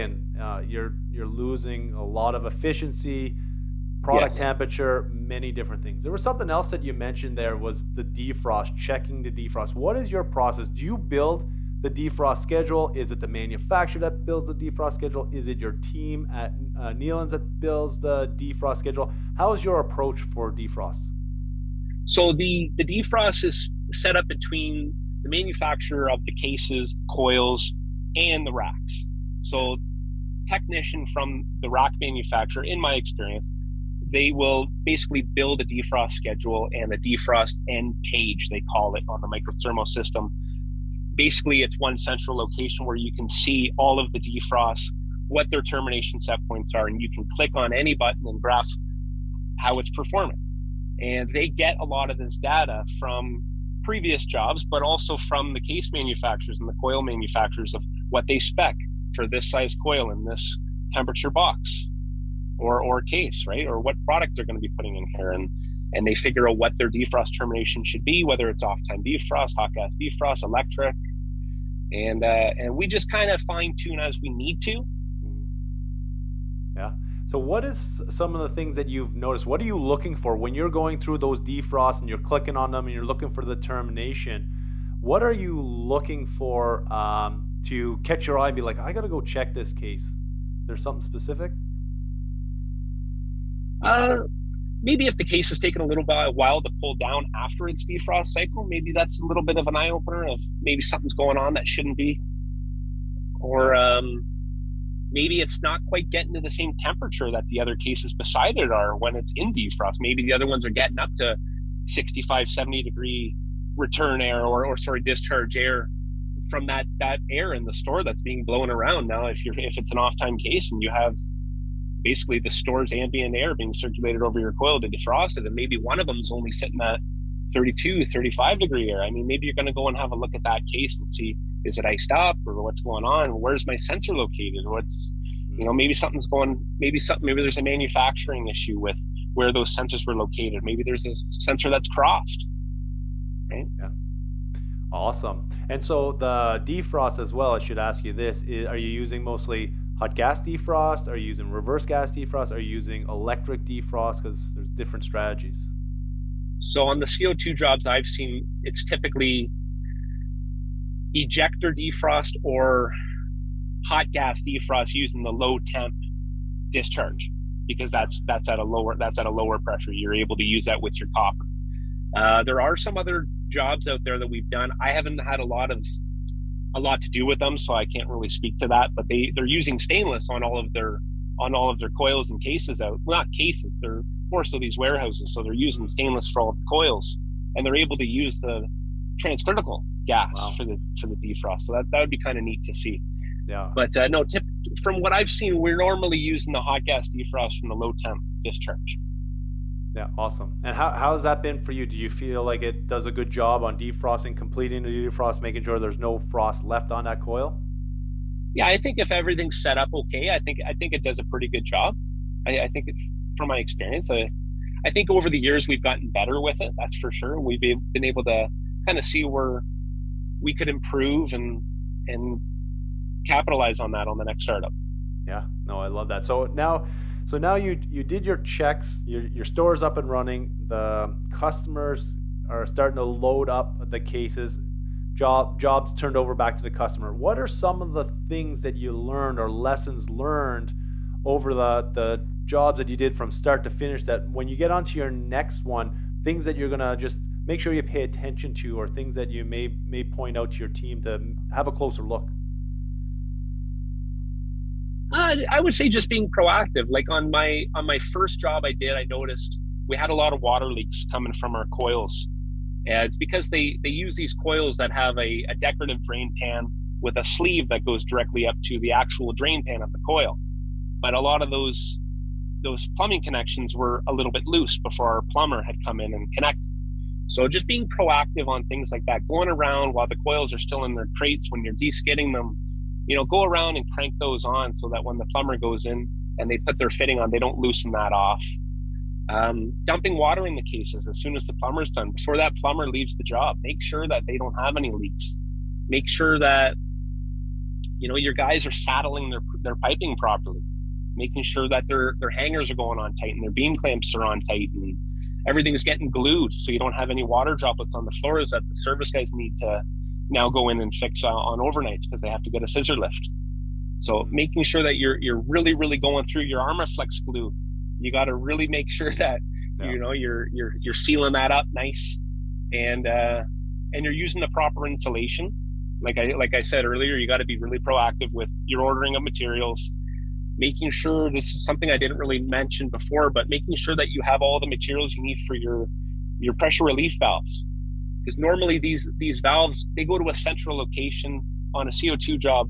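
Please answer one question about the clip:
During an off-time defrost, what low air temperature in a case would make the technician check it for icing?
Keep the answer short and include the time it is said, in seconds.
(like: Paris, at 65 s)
32 to 35 degrees, at 127 s.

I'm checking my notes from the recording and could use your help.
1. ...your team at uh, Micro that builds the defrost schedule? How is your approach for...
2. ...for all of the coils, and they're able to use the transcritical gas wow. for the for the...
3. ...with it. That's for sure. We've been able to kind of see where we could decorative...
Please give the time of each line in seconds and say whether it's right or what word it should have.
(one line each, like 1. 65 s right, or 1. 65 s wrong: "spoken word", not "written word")
1. 15 s wrong: "Neelands", not "Micro"
2. 186 s right
3. 216 s wrong: "improve", not "decorative".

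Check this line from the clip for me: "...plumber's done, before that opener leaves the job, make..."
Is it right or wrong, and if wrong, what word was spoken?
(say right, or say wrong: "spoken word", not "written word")
wrong: "plumber", not "opener".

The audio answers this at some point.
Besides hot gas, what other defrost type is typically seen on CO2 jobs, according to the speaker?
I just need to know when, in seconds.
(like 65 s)
161 s.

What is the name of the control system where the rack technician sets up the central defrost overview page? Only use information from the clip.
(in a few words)
Micro Thermo.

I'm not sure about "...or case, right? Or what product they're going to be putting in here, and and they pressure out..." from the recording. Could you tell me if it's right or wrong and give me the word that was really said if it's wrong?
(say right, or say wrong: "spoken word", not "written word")
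wrong: "figure", not "pressure".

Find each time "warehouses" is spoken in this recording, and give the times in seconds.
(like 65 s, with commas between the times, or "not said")
184 s.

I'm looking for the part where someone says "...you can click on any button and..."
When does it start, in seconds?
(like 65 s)
47 s.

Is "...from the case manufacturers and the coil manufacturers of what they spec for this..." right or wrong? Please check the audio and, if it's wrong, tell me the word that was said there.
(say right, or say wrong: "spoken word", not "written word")
right.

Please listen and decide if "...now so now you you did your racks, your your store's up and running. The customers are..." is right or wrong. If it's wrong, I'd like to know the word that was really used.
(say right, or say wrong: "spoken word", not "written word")
wrong: "checks", not "racks".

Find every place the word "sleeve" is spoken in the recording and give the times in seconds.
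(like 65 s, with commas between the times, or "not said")
267 s.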